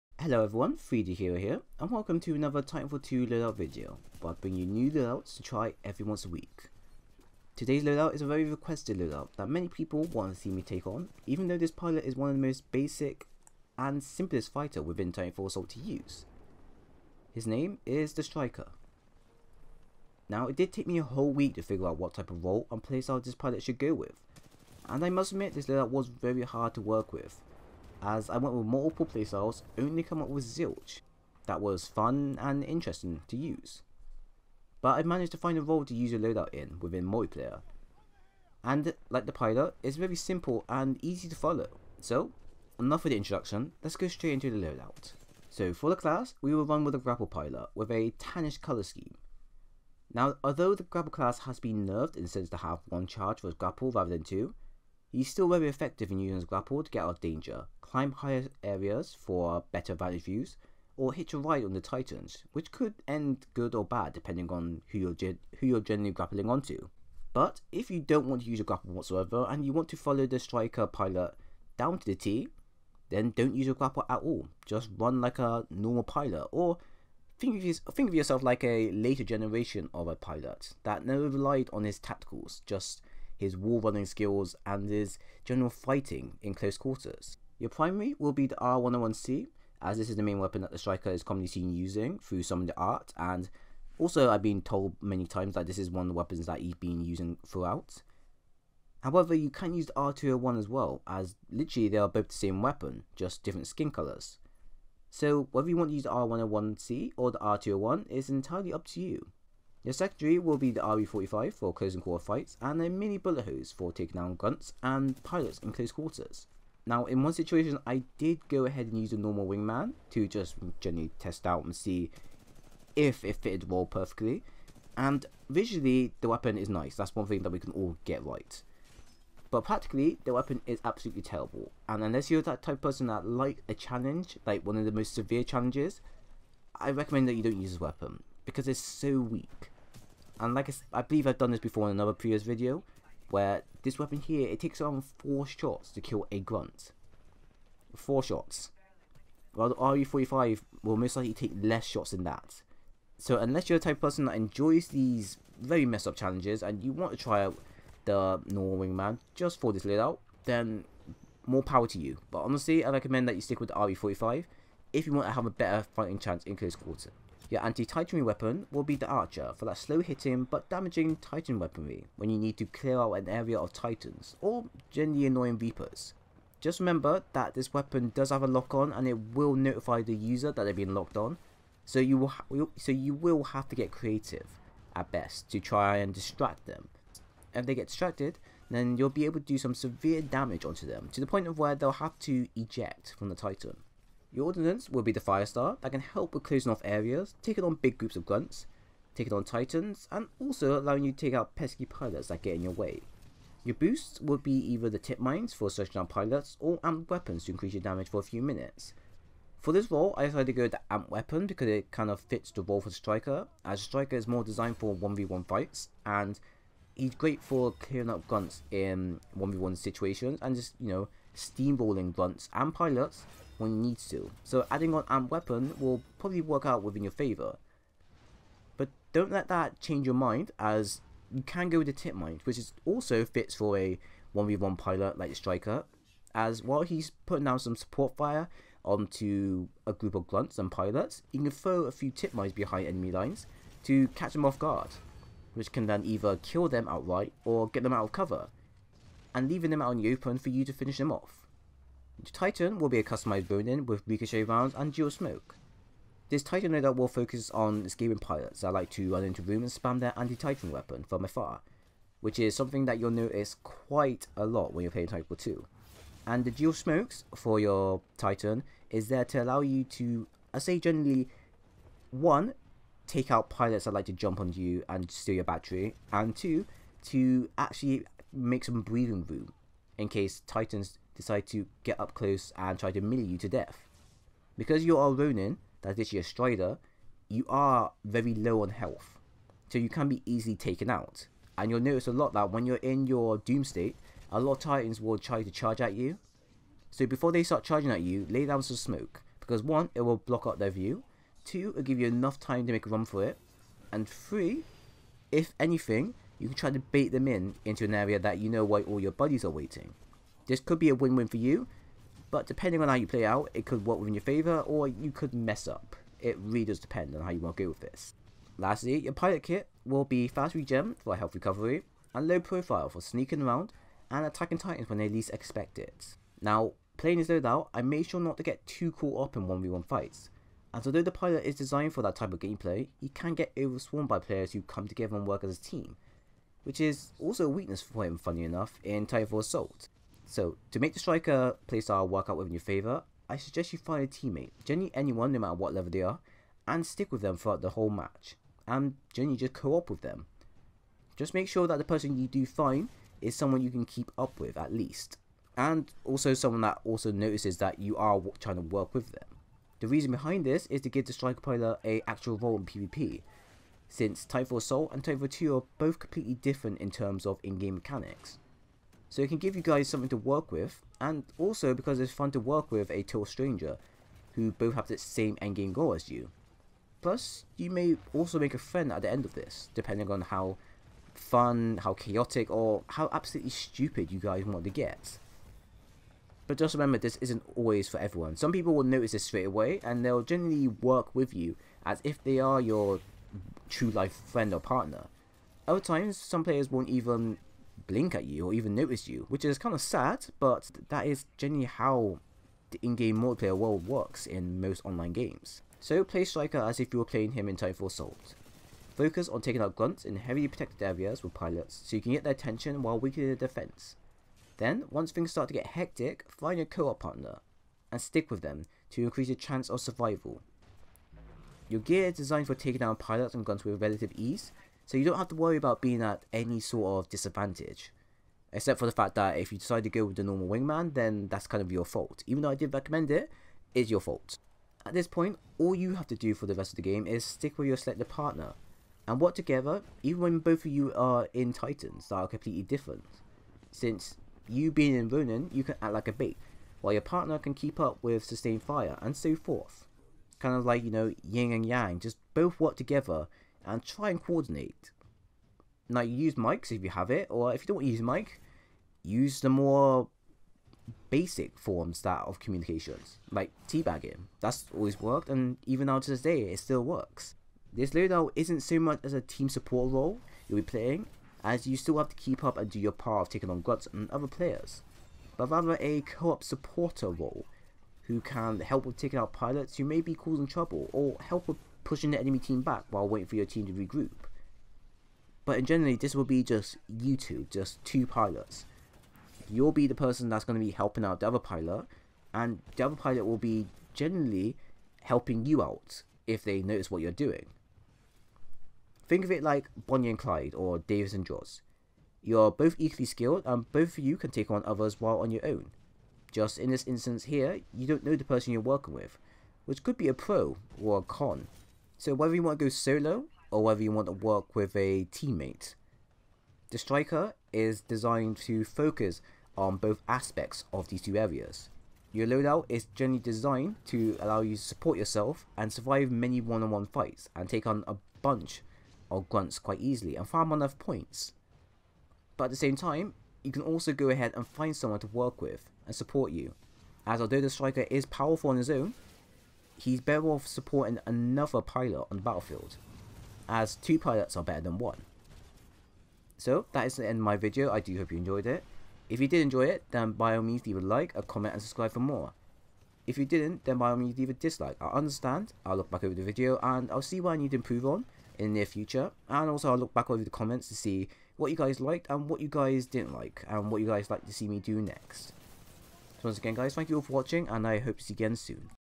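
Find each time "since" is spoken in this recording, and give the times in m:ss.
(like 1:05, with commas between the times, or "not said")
0:52, 6:03, 7:23.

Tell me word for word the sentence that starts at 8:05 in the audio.
But in generally, this will be just you two, just two pilots.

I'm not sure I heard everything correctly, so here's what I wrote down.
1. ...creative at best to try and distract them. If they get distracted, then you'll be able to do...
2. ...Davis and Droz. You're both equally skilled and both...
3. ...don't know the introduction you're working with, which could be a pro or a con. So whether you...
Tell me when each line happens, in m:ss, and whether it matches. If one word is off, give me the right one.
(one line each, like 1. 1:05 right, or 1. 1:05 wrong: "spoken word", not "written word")
1. 3:03 right
2. 8:20 right
3. 8:27 wrong: "person", not "introduction".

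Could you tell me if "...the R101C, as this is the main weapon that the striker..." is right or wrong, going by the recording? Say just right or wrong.
right.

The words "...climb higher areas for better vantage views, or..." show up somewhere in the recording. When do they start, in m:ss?
0:57.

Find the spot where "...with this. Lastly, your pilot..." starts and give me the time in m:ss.
5:17.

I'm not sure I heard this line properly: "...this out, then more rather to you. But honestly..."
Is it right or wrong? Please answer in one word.
wrong.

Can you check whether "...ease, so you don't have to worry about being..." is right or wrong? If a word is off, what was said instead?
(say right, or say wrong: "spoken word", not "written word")
right.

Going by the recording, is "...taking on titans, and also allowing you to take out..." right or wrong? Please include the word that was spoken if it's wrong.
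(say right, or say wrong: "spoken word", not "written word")
right.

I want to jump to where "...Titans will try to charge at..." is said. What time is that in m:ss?
4:54.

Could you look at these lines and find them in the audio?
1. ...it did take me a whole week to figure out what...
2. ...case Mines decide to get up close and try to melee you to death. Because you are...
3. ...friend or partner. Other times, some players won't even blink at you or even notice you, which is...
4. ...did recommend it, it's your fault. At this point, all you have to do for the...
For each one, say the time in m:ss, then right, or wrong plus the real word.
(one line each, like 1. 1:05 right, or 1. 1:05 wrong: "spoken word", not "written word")
1. 0:20 right
2. 4:40 wrong: "Titans", not "Mines"
3. 6:34 right
4. 7:12 right.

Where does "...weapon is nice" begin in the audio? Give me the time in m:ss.
2:06.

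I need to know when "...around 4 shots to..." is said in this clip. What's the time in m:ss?
2:24.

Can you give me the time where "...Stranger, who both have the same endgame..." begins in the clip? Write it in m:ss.
6:13.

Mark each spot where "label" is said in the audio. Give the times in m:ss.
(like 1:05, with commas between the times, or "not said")
not said.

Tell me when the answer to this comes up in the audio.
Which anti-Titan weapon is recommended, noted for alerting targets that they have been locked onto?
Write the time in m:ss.
2:49.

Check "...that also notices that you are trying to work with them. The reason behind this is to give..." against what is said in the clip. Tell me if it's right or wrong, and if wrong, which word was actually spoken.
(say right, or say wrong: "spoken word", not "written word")
right.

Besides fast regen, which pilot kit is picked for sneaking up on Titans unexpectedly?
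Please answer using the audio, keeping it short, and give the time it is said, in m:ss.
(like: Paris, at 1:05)
low profile, at 5:22.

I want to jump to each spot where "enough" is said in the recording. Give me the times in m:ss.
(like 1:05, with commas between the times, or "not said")
0:42, 5:02, 5:38, 8:50.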